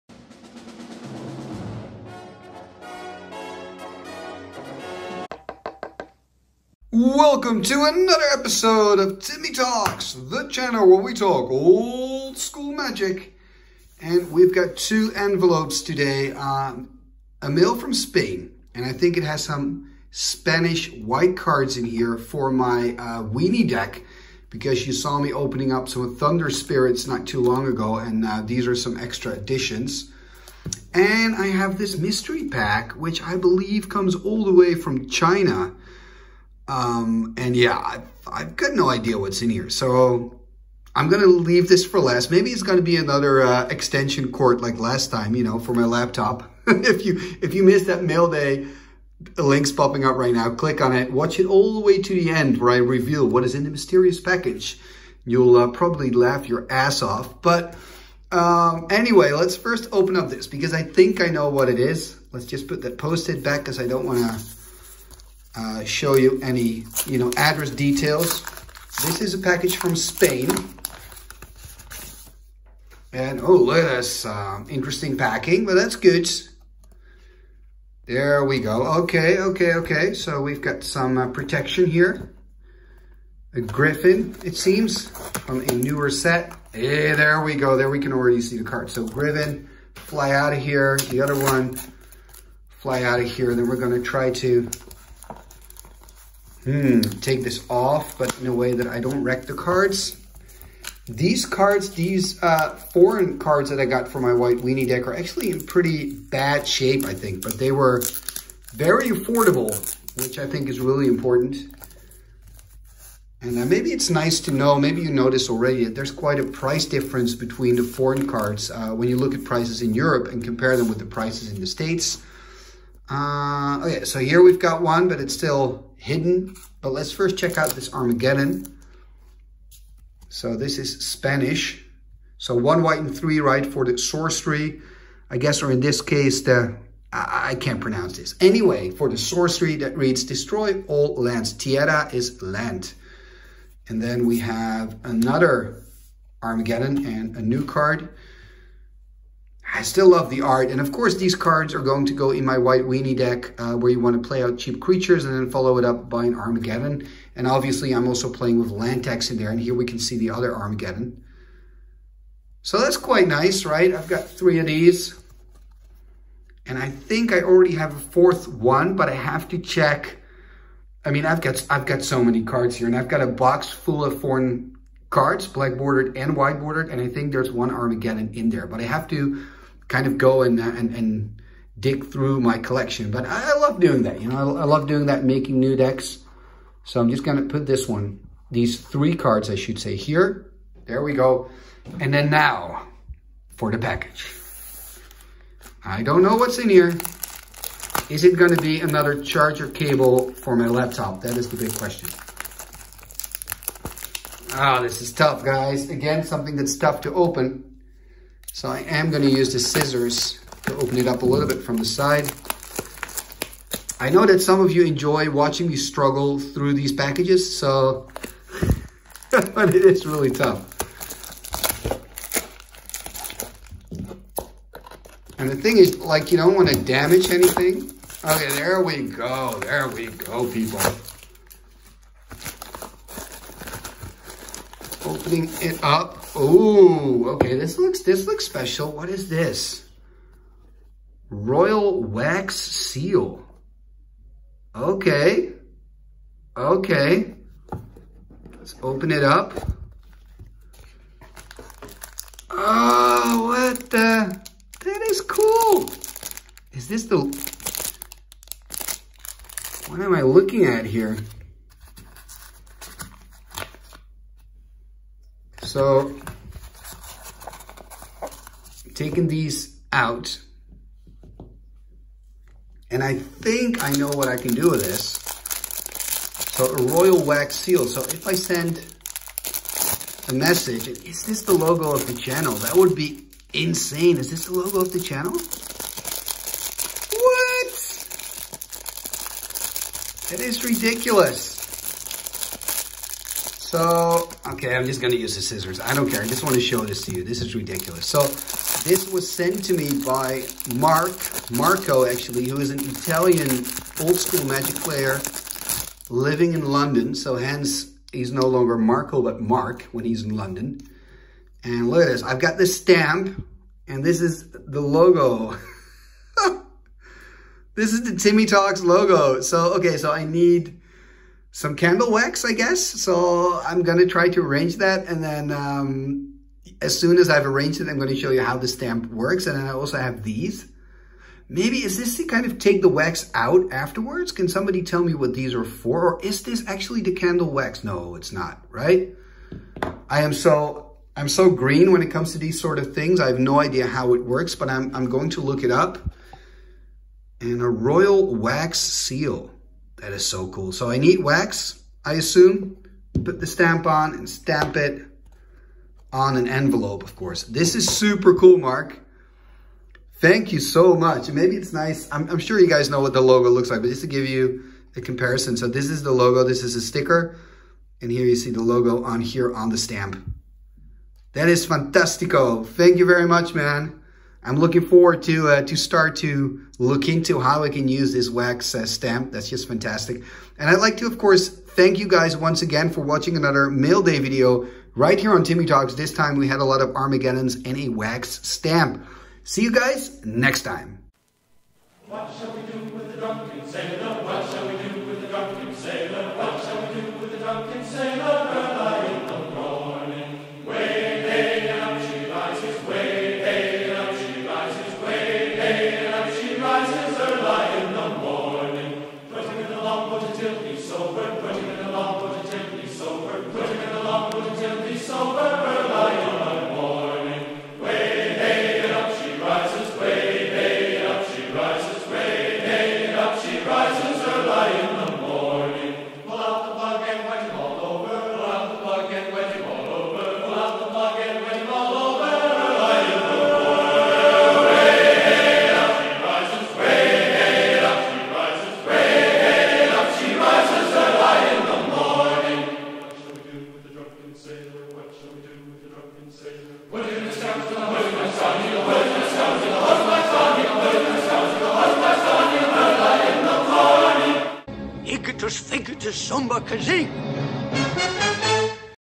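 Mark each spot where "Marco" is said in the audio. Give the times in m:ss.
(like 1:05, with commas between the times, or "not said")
5:01, 5:08.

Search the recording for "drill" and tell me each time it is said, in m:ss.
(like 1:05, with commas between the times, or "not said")
not said.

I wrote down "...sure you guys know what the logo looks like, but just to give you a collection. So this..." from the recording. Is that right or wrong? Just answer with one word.
wrong.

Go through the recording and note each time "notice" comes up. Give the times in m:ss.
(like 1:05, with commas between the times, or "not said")
1:55.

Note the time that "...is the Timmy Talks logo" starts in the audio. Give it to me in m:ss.
5:17.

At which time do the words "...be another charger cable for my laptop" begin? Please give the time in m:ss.
3:18.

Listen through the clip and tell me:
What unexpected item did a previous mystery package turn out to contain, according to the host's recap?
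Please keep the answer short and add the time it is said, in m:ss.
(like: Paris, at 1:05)
Extension cord, at 0:43.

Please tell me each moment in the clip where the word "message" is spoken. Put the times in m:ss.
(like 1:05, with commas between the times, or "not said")
4:40.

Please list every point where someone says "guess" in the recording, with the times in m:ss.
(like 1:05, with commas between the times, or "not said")
2:15, 5:22.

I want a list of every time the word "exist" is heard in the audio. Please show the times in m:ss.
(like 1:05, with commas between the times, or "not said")
not said.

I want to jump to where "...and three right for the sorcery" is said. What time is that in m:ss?
2:12.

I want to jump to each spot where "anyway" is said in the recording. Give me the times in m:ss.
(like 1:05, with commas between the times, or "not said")
0:58, 2:18.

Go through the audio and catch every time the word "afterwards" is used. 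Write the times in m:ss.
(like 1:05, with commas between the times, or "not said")
5:33.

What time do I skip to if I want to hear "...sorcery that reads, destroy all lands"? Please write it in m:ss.
2:19.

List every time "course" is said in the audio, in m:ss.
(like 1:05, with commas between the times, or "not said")
2:30, 5:57, 6:21.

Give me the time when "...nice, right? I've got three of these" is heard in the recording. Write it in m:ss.
2:43.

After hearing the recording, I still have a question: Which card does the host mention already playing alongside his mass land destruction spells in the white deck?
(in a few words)
Land Tax.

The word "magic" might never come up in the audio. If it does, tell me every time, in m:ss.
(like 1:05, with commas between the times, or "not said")
0:12, 5:04.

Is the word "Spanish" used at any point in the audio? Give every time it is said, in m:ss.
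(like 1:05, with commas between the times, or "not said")
0:20, 2:11.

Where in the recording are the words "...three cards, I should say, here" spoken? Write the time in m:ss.
3:08.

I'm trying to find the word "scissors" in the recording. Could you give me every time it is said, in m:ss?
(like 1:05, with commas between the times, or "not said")
3:29, 4:55.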